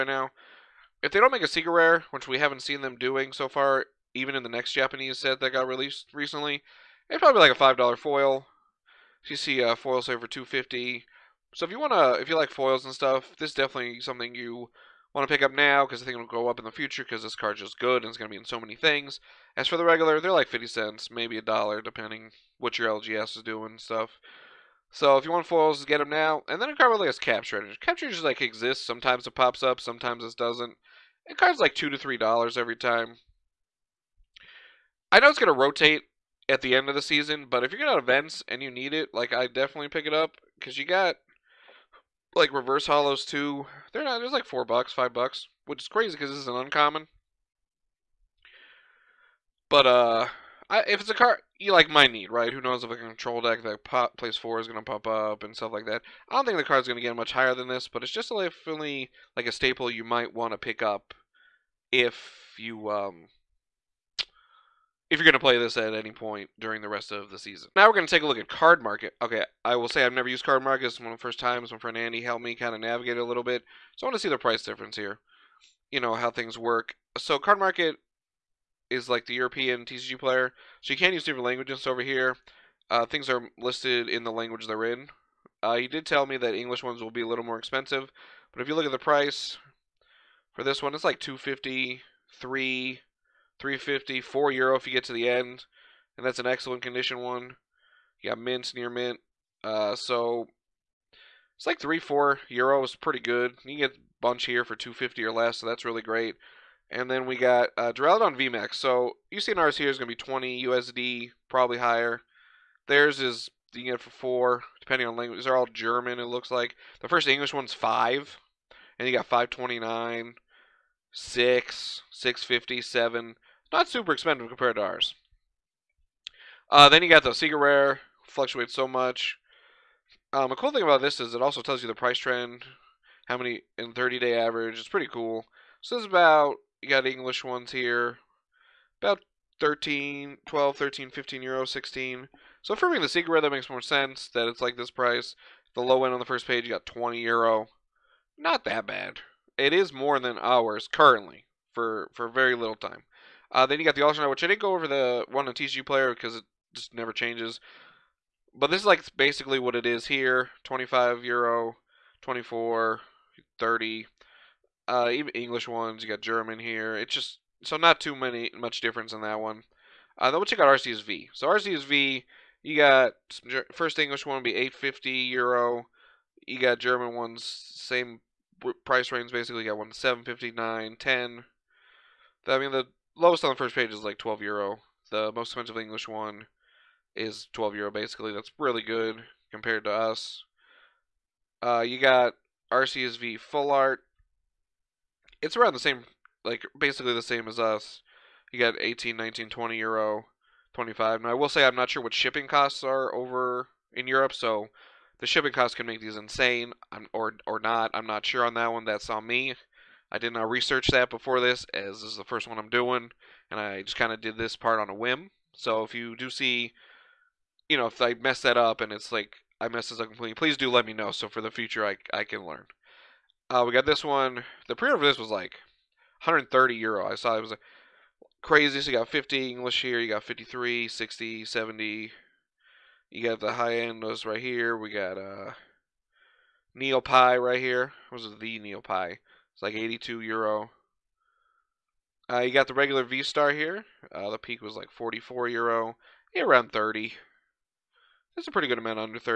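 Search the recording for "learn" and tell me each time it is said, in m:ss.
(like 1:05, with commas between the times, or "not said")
3:42.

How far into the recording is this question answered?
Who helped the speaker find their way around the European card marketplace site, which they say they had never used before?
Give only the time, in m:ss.
1:11.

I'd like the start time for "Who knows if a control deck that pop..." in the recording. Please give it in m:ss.
0:52.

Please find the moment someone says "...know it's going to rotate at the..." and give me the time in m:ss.
0:35.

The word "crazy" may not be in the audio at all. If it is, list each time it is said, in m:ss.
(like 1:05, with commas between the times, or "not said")
0:45, 3:48.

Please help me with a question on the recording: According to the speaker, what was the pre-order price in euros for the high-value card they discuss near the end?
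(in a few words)
130 euro.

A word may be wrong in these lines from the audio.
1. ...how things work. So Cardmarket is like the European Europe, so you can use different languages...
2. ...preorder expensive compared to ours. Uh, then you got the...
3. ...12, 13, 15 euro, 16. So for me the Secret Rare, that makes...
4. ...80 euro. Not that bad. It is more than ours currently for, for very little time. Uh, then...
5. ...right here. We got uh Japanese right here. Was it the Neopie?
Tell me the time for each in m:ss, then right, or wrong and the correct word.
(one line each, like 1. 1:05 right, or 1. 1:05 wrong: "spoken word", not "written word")
1. 1:16 wrong: "TCGPlayer", not "Europe"
2. 2:03 wrong: "super", not "preorder"
3. 2:20 right
4. 2:26 wrong: "20", not "80"
5. 3:54 wrong: "Neopie", not "Japanese".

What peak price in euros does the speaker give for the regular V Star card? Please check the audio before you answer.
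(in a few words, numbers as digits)
44 euro.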